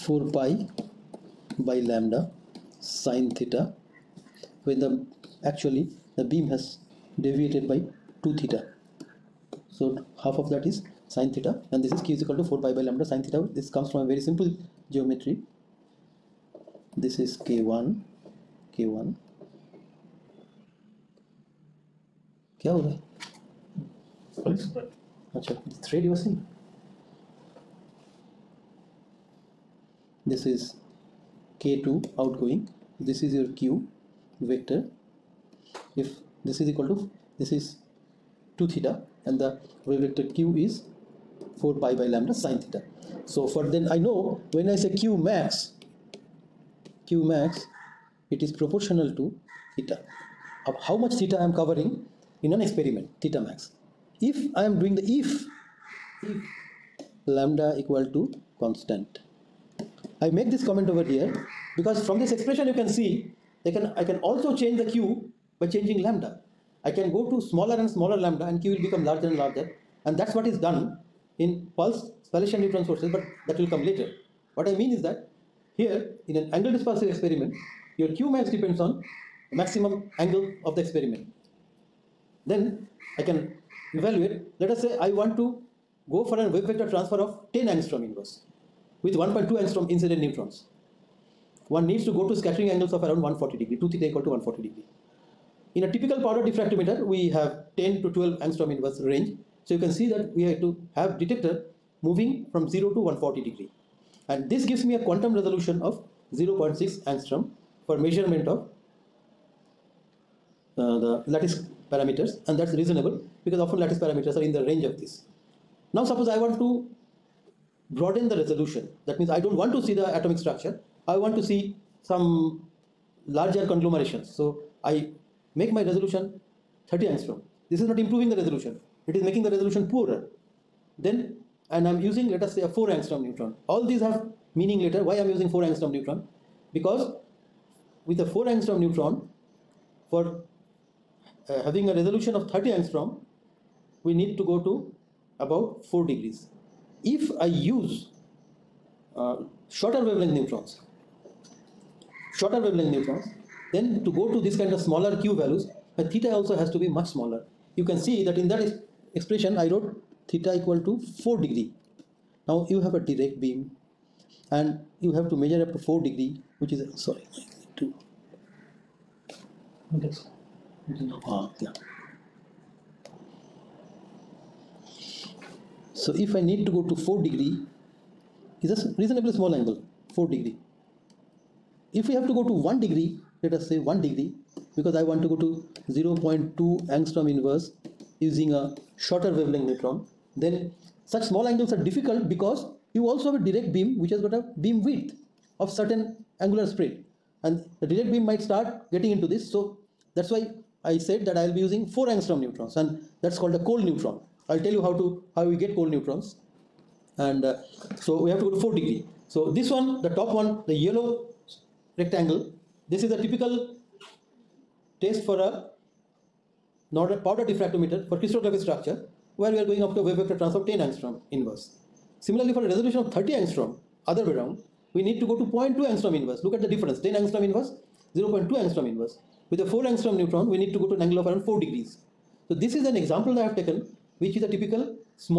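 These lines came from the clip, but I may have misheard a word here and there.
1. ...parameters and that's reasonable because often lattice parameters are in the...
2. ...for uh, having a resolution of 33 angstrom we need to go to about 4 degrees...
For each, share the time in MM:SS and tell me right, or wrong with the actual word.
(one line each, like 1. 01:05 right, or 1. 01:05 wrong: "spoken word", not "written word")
1. 01:51 right
2. 02:20 wrong: "30", not "33".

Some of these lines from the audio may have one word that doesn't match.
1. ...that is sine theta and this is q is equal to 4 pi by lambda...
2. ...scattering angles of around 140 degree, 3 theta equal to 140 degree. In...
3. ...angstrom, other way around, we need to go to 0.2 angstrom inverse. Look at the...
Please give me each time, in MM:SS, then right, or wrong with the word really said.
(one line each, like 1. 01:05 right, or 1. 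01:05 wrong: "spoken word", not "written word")
1. 00:10 right
2. 01:32 wrong: "2", not "3"
3. 03:43 right.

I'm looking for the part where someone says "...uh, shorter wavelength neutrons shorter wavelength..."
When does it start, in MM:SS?
02:29.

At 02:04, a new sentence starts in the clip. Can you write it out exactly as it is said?
So I make my resolution 30 angstrom.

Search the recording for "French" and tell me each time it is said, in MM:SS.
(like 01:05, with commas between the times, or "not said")
not said.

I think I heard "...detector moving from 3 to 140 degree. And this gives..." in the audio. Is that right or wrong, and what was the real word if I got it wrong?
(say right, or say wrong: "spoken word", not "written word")
wrong: "0", not "3".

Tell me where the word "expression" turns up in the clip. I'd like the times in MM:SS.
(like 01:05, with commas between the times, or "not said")
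01:02, 02:39.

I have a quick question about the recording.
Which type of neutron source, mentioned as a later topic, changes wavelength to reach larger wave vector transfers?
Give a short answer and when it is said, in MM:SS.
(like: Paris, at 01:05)
pulse spallation neutron sources, at 01:11.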